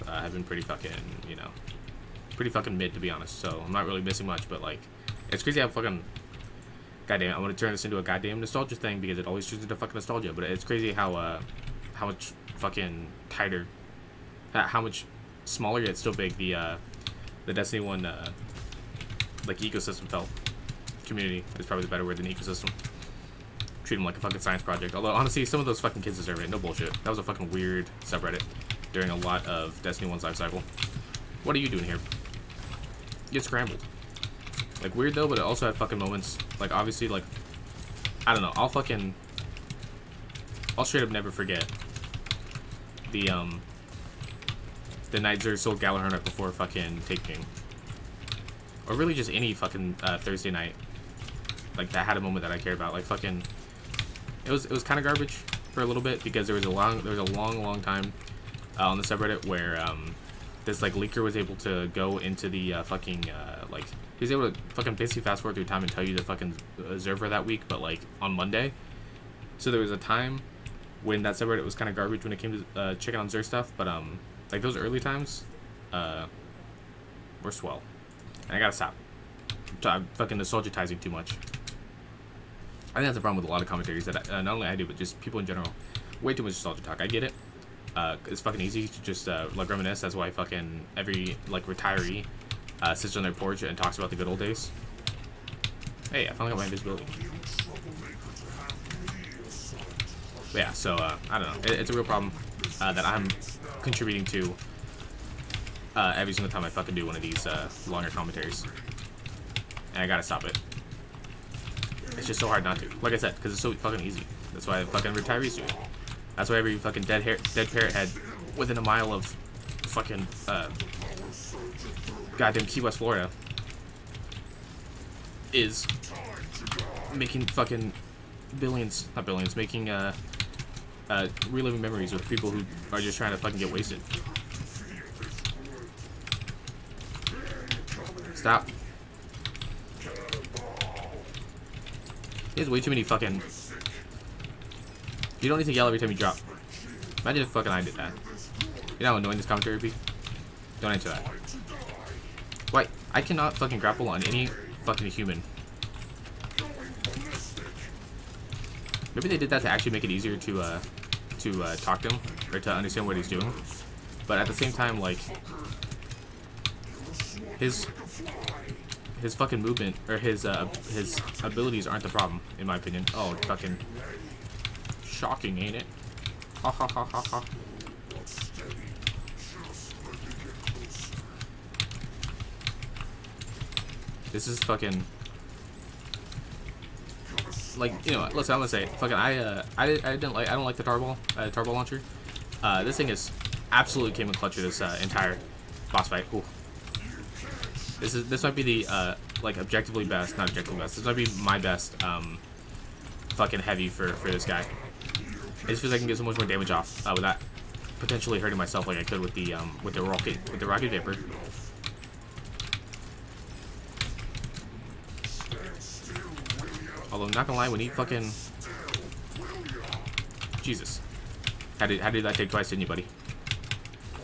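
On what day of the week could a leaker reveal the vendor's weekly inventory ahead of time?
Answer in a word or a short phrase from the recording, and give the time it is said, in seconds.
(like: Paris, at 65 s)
Monday, at 68 s.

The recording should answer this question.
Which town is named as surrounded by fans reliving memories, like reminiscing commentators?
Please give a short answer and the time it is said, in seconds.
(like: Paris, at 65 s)
Key West, Florida, at 122 s.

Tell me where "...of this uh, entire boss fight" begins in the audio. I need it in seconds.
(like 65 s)
194 s.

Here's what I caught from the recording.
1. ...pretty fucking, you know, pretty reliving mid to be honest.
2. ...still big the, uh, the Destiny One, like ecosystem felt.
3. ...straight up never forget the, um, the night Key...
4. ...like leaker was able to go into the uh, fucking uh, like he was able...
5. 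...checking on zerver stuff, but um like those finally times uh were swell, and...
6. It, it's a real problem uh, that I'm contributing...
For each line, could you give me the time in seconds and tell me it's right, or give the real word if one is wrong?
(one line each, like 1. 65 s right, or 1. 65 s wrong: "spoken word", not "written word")
1. 0 s wrong: "fucking", not "reliving"
2. 15 s right
3. 40 s wrong: "Xur", not "Key"
4. 60 s right
5. 72 s wrong: "early", not "finally"
6. 101 s right.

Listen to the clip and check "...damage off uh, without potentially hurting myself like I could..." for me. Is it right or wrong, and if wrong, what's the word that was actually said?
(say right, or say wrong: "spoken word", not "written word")
right.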